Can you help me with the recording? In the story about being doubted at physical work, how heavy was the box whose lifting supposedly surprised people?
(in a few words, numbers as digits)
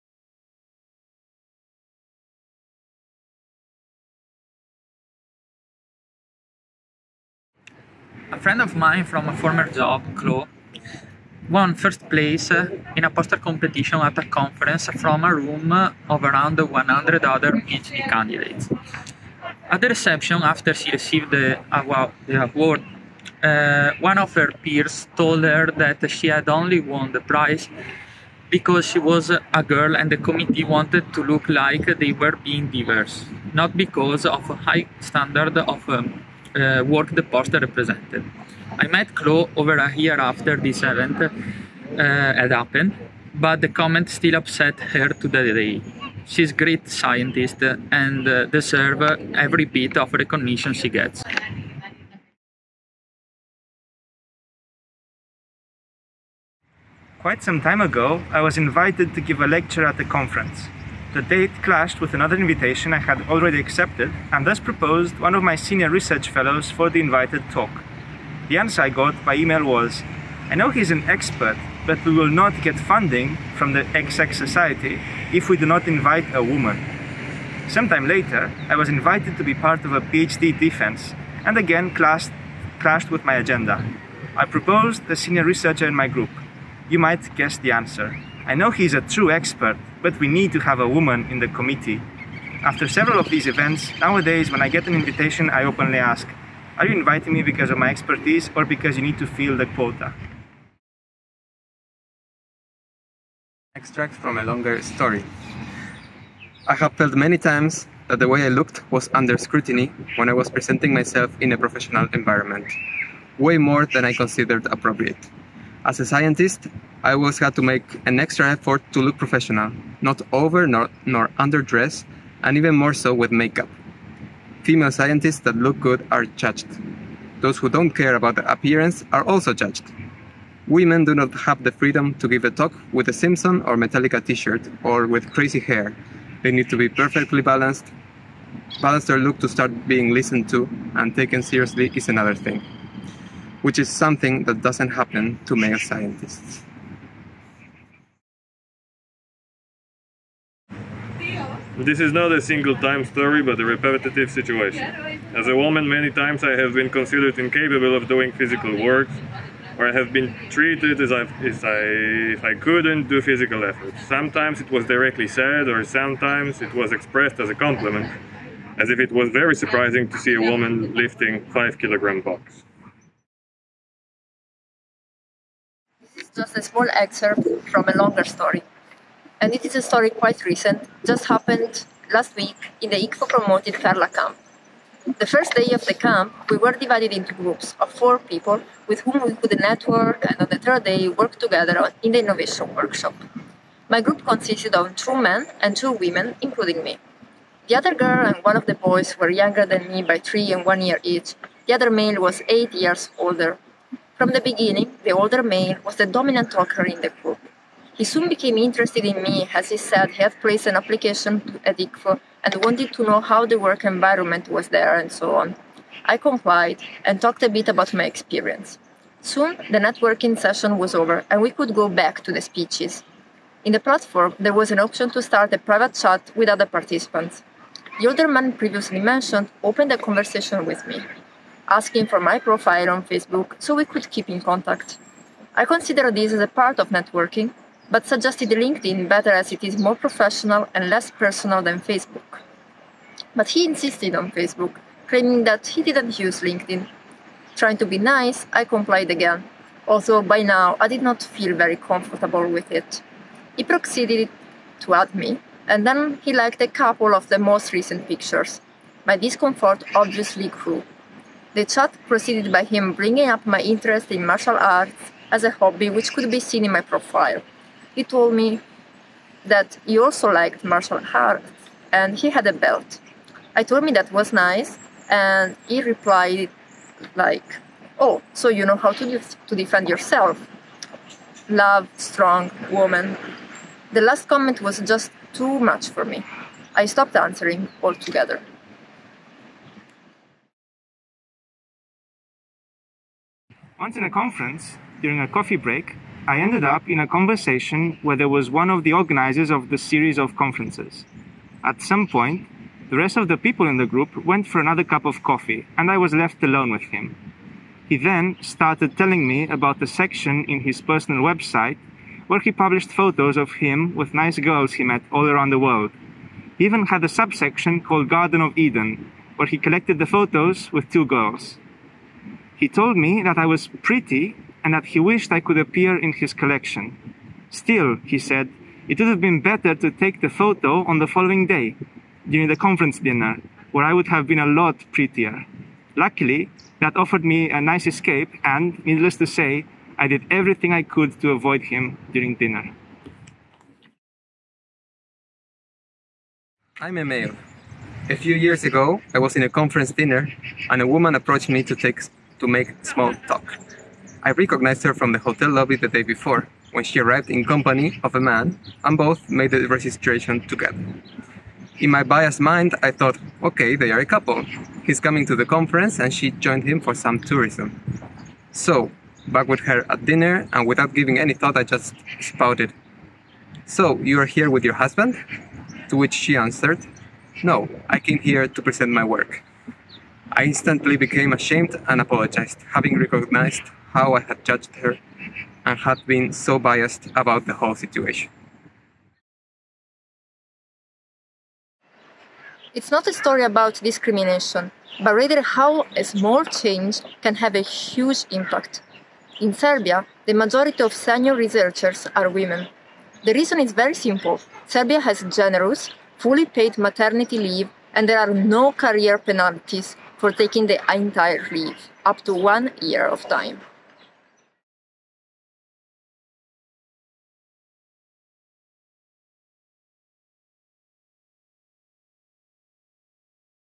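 5 kilograms.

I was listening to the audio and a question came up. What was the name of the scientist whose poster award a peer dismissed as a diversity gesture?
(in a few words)
Chloe.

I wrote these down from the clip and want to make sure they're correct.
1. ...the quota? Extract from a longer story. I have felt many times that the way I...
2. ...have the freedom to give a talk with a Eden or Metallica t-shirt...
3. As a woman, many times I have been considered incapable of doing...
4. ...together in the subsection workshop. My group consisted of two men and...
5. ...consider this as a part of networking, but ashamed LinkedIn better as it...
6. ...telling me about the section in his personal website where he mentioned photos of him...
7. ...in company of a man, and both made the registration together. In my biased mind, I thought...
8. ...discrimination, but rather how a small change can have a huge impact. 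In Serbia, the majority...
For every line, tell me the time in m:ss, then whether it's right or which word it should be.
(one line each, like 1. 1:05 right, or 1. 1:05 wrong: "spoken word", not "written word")
1. 1:39 right
2. 2:11 wrong: "Simpson", not "Eden"
3. 2:35 right
4. 3:11 wrong: "innovation", not "subsection"
5. 3:55 wrong: "suggested", not "ashamed"
6. 5:08 wrong: "published", not "mentioned"
7. 5:57 right
8. 6:33 right.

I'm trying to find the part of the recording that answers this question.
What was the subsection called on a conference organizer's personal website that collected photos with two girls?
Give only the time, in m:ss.
5:18.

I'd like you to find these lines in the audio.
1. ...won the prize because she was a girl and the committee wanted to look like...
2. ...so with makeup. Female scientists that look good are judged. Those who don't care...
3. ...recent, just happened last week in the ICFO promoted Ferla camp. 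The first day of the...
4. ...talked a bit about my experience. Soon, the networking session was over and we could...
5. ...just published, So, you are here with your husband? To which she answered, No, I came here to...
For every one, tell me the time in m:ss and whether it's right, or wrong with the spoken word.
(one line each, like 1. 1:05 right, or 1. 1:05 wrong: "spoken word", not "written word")
1. 0:26 right
2. 2:02 right
3. 3:00 right
4. 3:37 right
5. 6:11 wrong: "spouted", not "published".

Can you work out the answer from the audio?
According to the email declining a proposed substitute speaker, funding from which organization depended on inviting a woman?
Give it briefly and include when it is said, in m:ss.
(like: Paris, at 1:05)
XX Society, at 1:13.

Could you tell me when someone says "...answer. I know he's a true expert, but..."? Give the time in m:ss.
1:27.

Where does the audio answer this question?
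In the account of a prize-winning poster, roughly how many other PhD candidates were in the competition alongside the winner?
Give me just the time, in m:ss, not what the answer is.
0:16.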